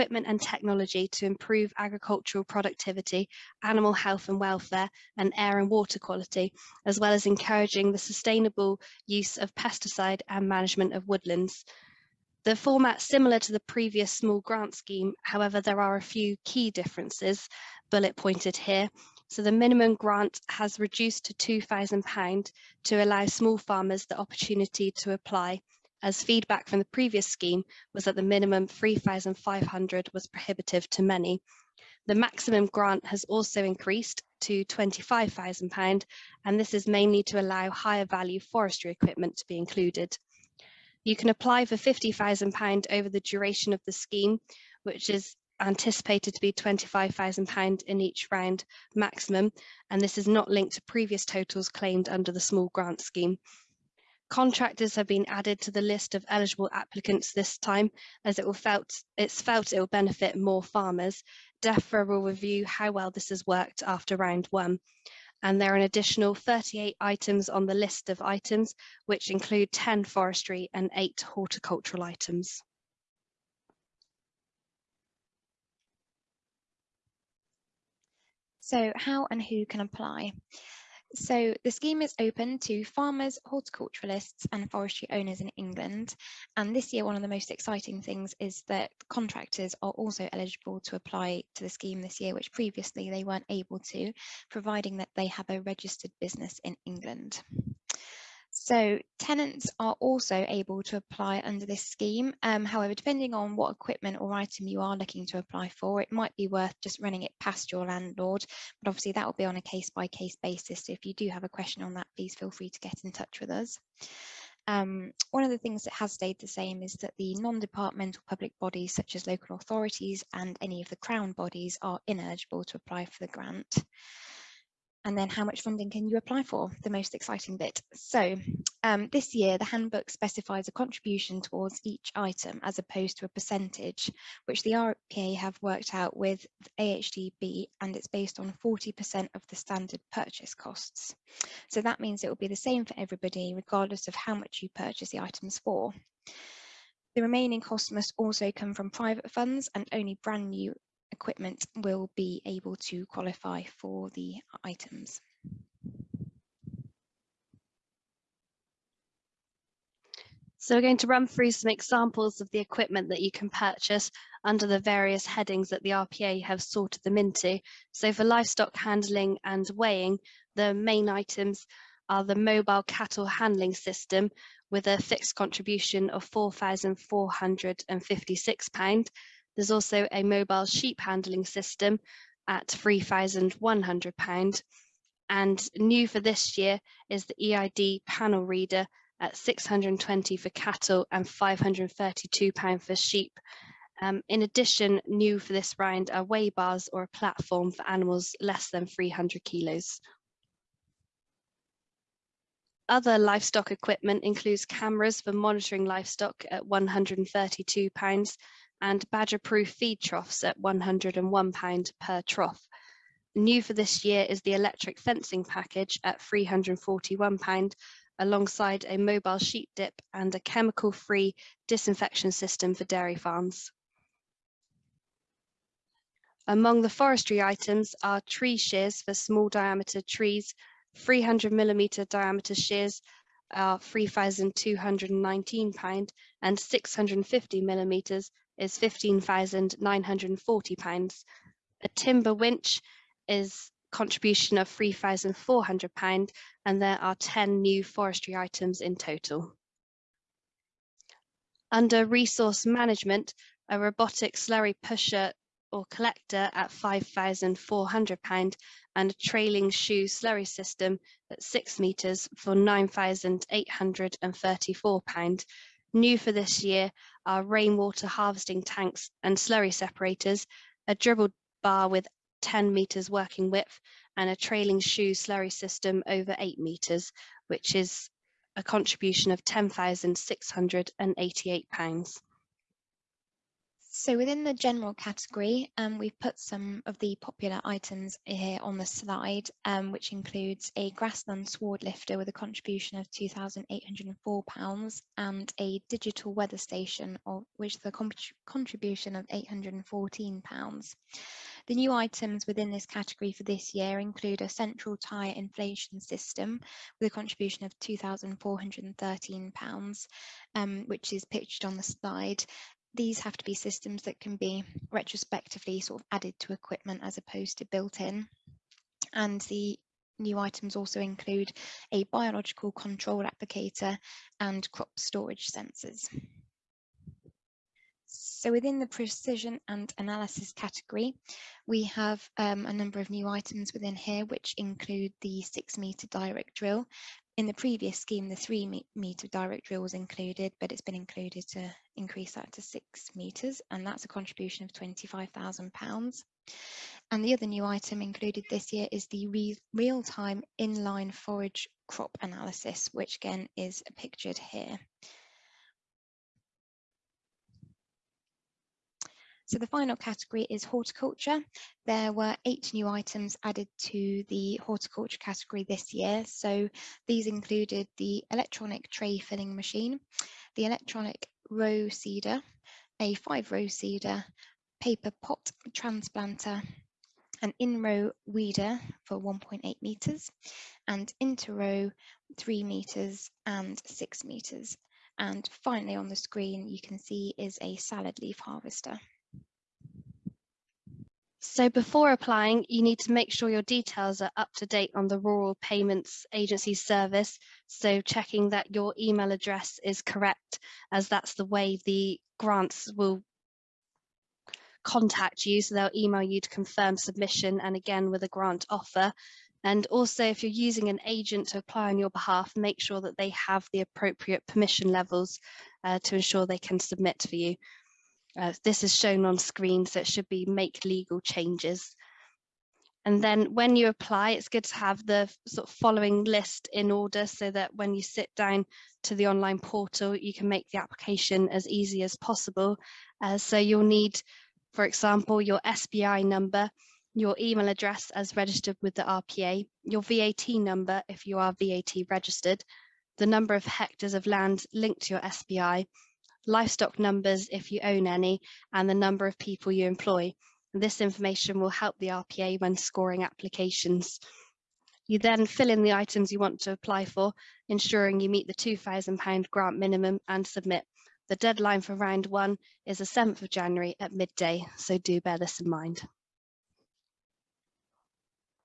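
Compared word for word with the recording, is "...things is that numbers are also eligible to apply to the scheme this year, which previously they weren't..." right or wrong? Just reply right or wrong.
wrong.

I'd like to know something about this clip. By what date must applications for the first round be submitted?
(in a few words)
7 January.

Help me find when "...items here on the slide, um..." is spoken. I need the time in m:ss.
4:47.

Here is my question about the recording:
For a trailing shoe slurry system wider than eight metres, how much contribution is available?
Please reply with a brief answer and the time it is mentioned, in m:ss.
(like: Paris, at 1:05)
£10,688, at 4:39.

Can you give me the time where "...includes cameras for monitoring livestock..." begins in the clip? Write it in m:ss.
3:24.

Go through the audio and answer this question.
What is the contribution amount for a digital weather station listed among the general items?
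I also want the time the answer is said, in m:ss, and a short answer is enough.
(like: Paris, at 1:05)
£814, at 4:59.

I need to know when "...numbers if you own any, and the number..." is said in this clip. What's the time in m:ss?
7:26.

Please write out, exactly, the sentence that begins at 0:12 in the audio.
The format similar to the previous small grant scheme, however, there are a few key differences bullet pointed here.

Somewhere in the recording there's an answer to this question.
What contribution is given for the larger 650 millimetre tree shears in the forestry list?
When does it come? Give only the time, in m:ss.
3:58.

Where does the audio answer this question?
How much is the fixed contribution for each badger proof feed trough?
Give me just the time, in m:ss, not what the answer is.
3:30.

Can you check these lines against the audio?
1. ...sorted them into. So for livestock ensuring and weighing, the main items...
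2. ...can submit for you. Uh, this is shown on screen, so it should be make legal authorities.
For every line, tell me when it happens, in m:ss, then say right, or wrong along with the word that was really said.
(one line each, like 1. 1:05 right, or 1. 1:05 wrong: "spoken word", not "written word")
1. 2:46 wrong: "handling", not "ensuring"
2. 6:56 wrong: "changes", not "authorities".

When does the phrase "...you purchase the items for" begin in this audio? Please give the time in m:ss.
2:24.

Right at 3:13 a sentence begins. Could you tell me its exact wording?
Um, in addition, new for this round are weigh bars or a platform for animals less than 300 kilos.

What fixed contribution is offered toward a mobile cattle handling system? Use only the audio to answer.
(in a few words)
£4,456.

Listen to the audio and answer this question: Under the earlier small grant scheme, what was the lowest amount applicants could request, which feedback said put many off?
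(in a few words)
£3,500.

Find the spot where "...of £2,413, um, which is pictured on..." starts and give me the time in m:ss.
5:07.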